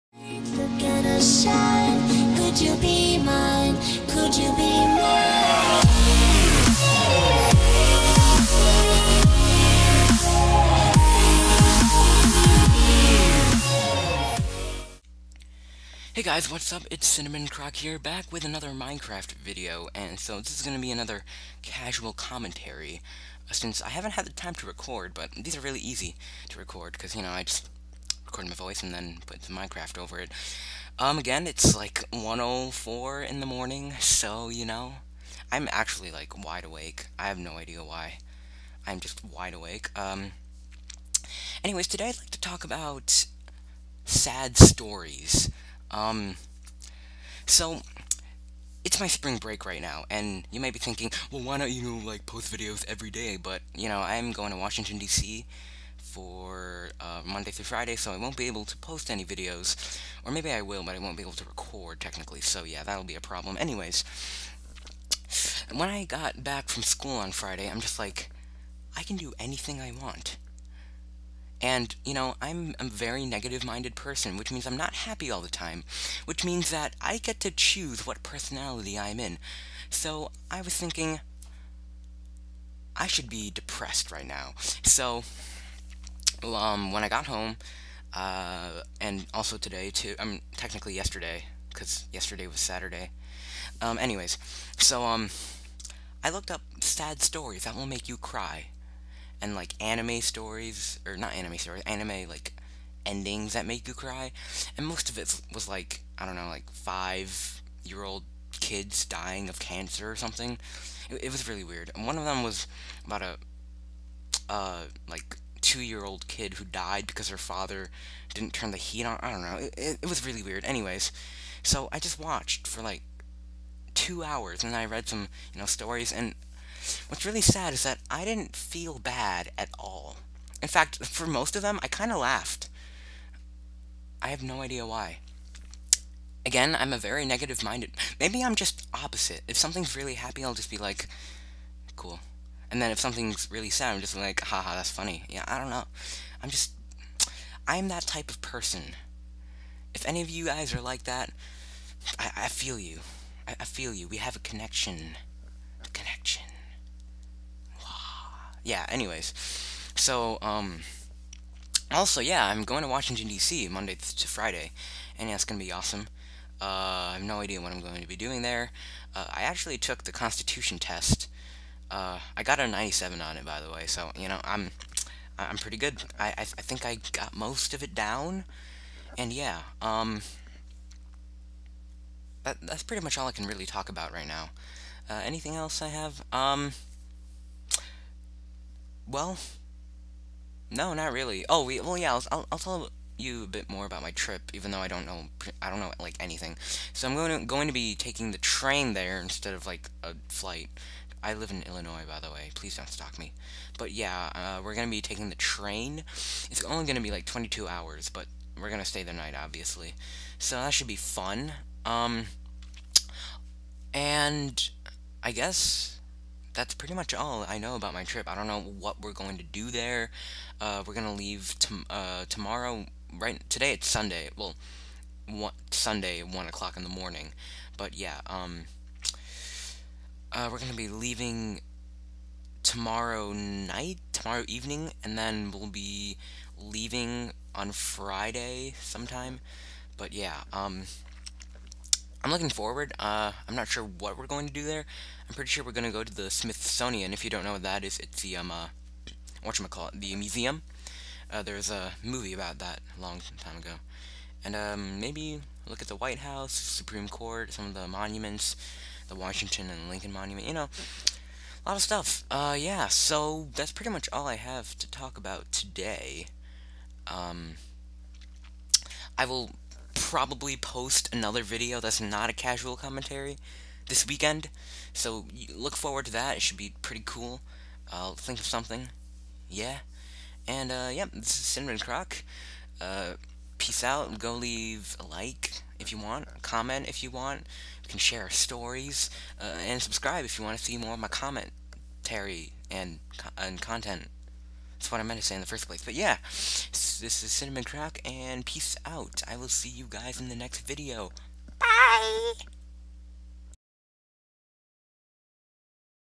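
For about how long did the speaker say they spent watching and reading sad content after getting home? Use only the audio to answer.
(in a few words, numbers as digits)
2 hours.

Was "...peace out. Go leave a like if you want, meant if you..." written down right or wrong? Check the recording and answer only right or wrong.
wrong.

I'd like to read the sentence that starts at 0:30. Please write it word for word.
Um, again, it's like 104 in the morning, so you know, I'm actually like wide awake.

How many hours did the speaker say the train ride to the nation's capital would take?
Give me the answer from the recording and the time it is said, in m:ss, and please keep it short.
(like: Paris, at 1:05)
22, at 3:27.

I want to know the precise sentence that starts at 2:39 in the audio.
So, um, also, yeah, I'm going to Washington, D.C.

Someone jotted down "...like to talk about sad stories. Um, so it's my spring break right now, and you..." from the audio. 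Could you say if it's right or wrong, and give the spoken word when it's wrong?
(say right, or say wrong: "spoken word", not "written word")
right.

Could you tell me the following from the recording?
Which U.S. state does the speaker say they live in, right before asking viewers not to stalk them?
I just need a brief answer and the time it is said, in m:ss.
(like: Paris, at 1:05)
Illinois, at 3:21.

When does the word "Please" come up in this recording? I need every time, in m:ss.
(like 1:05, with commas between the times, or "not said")
3:22.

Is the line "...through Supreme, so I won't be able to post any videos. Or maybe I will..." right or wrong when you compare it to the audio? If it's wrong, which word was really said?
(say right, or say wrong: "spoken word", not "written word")
wrong: "Friday", not "Supreme".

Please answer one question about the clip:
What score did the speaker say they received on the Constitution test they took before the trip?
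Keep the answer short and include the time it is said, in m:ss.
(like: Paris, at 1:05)
97, at 2:52.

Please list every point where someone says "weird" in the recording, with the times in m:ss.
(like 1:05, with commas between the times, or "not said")
1:51, 2:00.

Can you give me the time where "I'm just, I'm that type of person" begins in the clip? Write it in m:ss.
2:26.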